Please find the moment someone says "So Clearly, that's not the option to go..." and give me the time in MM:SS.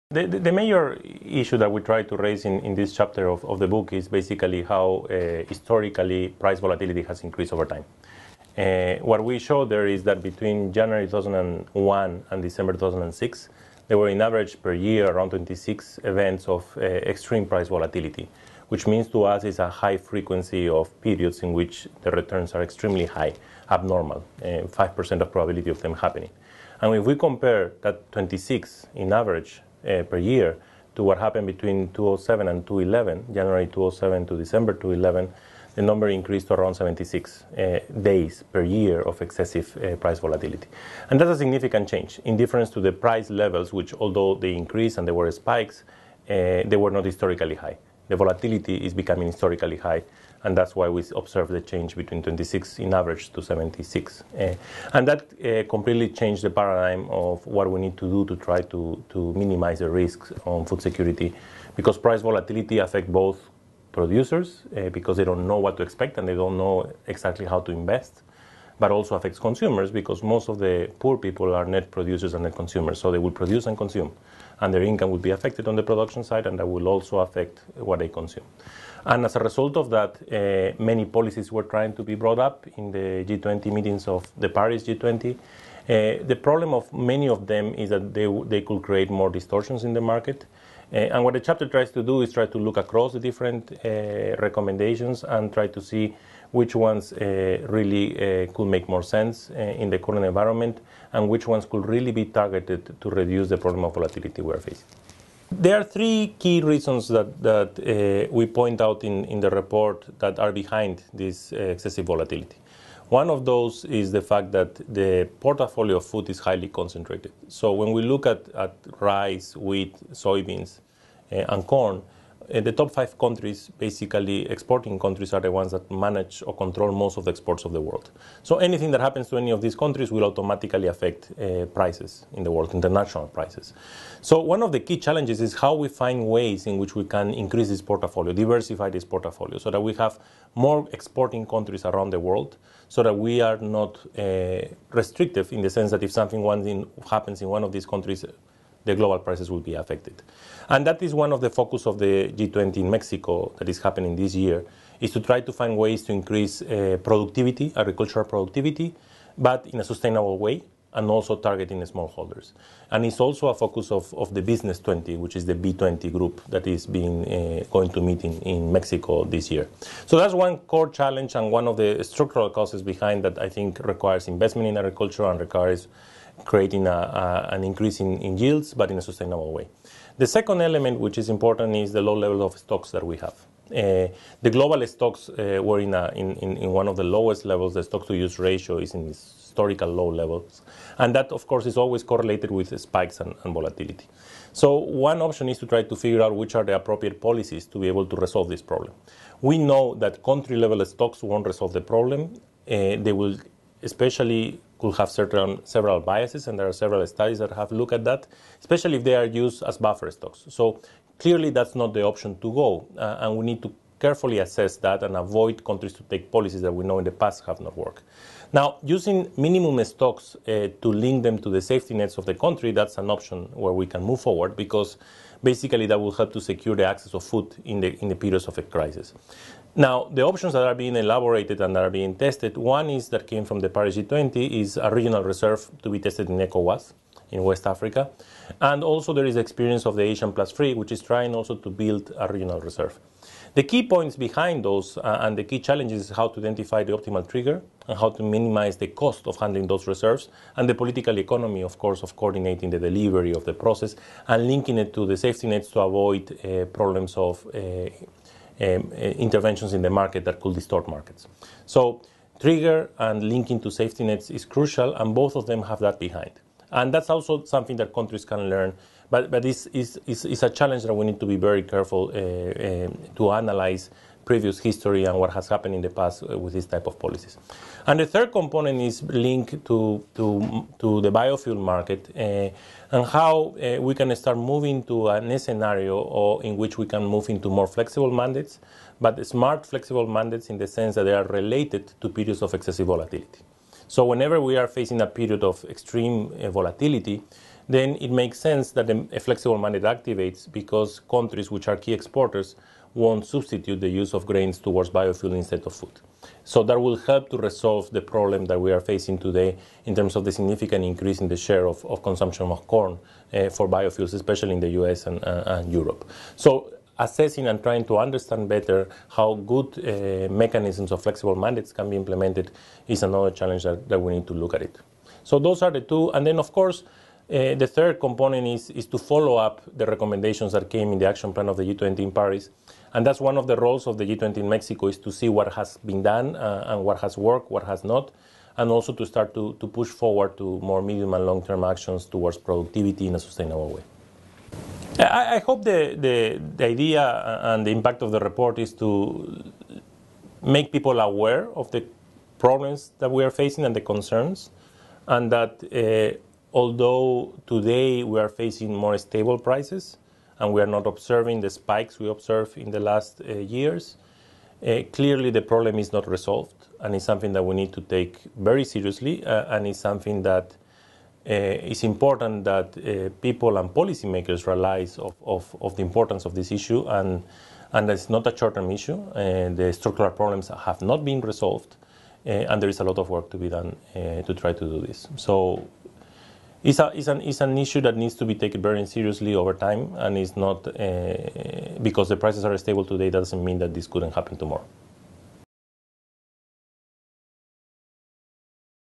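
03:30.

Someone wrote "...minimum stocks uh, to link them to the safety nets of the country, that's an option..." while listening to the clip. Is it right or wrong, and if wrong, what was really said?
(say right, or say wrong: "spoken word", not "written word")
right.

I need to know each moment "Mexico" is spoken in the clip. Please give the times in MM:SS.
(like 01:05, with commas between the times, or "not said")
02:32, 02:48, 05:34.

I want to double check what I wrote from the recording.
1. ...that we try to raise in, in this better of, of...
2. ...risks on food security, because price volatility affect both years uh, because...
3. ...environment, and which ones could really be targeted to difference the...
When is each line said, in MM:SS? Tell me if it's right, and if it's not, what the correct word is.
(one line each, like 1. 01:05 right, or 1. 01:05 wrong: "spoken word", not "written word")
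1. 00:01 wrong: "chapter", not "better"
2. 00:59 wrong: "producers", not "years"
3. 01:40 wrong: "reduce", not "difference".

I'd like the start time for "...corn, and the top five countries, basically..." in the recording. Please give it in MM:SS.
02:01.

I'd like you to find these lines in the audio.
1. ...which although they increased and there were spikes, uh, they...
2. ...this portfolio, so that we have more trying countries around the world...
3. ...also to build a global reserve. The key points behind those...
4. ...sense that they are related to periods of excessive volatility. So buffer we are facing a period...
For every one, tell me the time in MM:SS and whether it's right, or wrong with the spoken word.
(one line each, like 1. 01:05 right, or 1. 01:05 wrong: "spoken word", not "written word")
1. 00:43 right
2. 02:18 wrong: "exporting", not "trying"
3. 04:01 wrong: "regional", not "global"
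4. 04:50 wrong: "whenever", not "buffer".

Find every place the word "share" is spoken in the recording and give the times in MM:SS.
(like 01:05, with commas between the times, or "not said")
05:11.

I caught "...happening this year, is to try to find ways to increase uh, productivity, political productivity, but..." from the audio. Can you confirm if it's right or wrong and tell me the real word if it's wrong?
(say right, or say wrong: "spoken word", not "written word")
wrong: "agricultural", not "political".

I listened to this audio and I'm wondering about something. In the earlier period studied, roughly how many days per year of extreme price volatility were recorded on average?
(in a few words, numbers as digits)
26.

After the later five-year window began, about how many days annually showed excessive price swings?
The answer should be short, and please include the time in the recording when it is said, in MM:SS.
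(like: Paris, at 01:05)
76, at 00:36.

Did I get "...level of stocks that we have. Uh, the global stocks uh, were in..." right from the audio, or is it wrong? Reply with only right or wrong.
right.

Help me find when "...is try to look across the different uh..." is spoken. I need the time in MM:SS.
01:32.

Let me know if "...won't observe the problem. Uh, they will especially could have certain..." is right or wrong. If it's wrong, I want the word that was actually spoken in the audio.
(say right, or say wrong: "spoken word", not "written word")
wrong: "resolve", not "observe".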